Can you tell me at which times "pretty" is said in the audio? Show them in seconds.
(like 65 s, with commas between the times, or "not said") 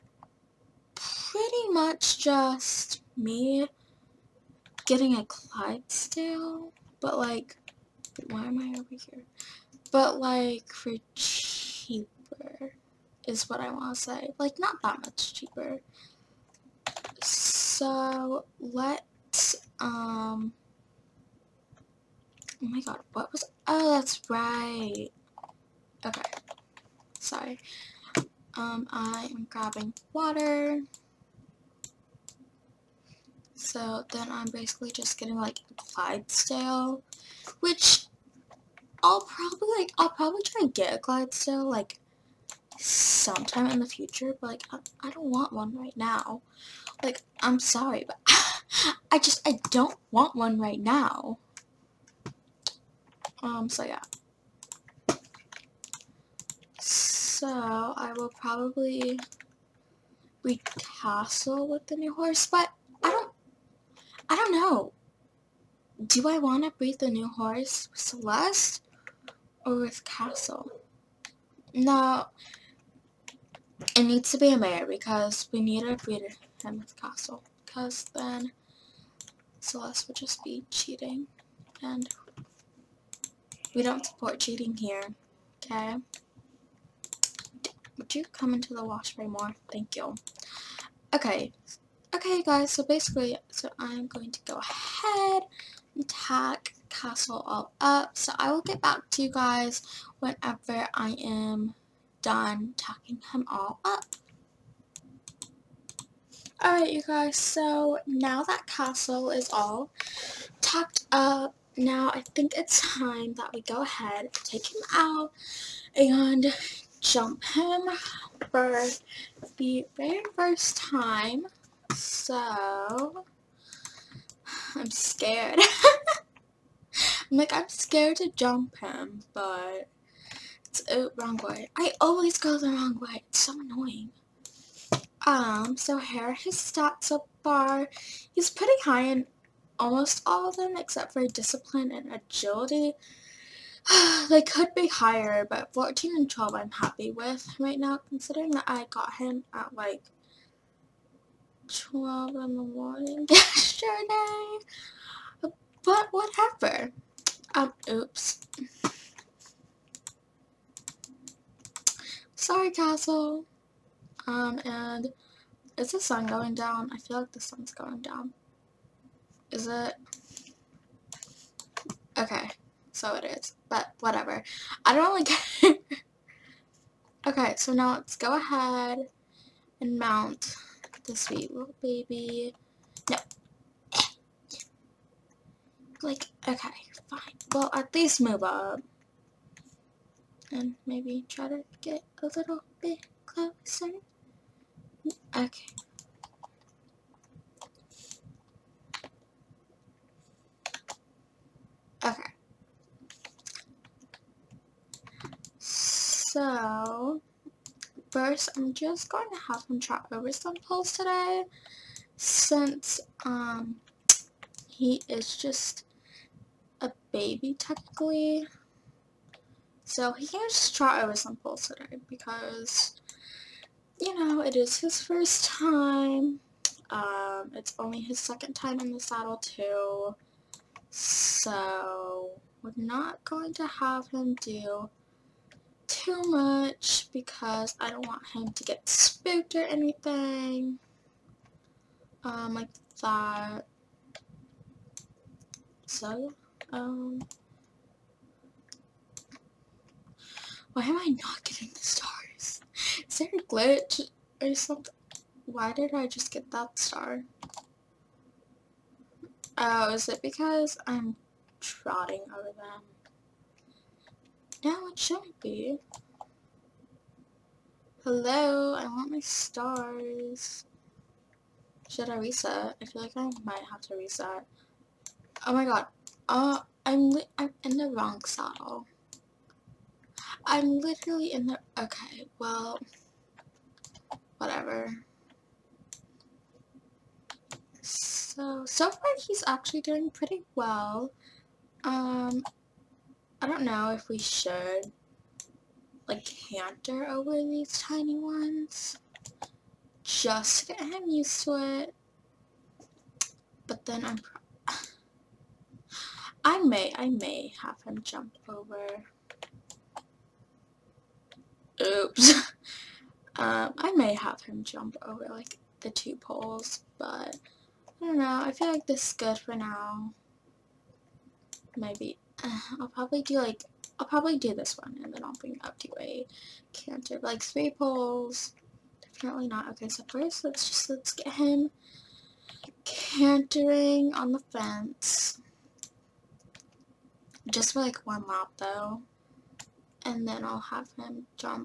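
0 s, 138 s, 290 s.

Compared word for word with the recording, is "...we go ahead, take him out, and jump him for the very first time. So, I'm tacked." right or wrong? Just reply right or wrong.
wrong.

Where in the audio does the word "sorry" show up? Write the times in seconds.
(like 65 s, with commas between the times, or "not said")
27 s, 47 s, 162 s.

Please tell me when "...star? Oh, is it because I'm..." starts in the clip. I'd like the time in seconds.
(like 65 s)
256 s.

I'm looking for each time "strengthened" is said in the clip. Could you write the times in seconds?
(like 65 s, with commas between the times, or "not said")
not said.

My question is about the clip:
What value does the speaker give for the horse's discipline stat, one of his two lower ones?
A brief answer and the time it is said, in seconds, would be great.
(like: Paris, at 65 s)
14, at 145 s.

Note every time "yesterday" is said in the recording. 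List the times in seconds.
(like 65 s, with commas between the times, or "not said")
153 s.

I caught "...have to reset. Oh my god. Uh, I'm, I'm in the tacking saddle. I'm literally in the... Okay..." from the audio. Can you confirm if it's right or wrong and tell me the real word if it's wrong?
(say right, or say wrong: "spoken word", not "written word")
wrong: "wrong", not "tacking".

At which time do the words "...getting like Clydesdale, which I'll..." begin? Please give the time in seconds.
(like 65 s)
35 s.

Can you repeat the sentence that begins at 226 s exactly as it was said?
Um, it's only his second time in the saddle too.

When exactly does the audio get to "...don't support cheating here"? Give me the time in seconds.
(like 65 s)
83 s.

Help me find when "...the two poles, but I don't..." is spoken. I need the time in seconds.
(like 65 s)
315 s.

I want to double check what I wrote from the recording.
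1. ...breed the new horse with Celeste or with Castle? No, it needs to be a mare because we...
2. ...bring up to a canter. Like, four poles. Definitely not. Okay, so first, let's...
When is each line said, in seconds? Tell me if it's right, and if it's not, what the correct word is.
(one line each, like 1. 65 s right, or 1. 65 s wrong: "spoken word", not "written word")
1. 66 s right
2. 325 s wrong: "three", not "four".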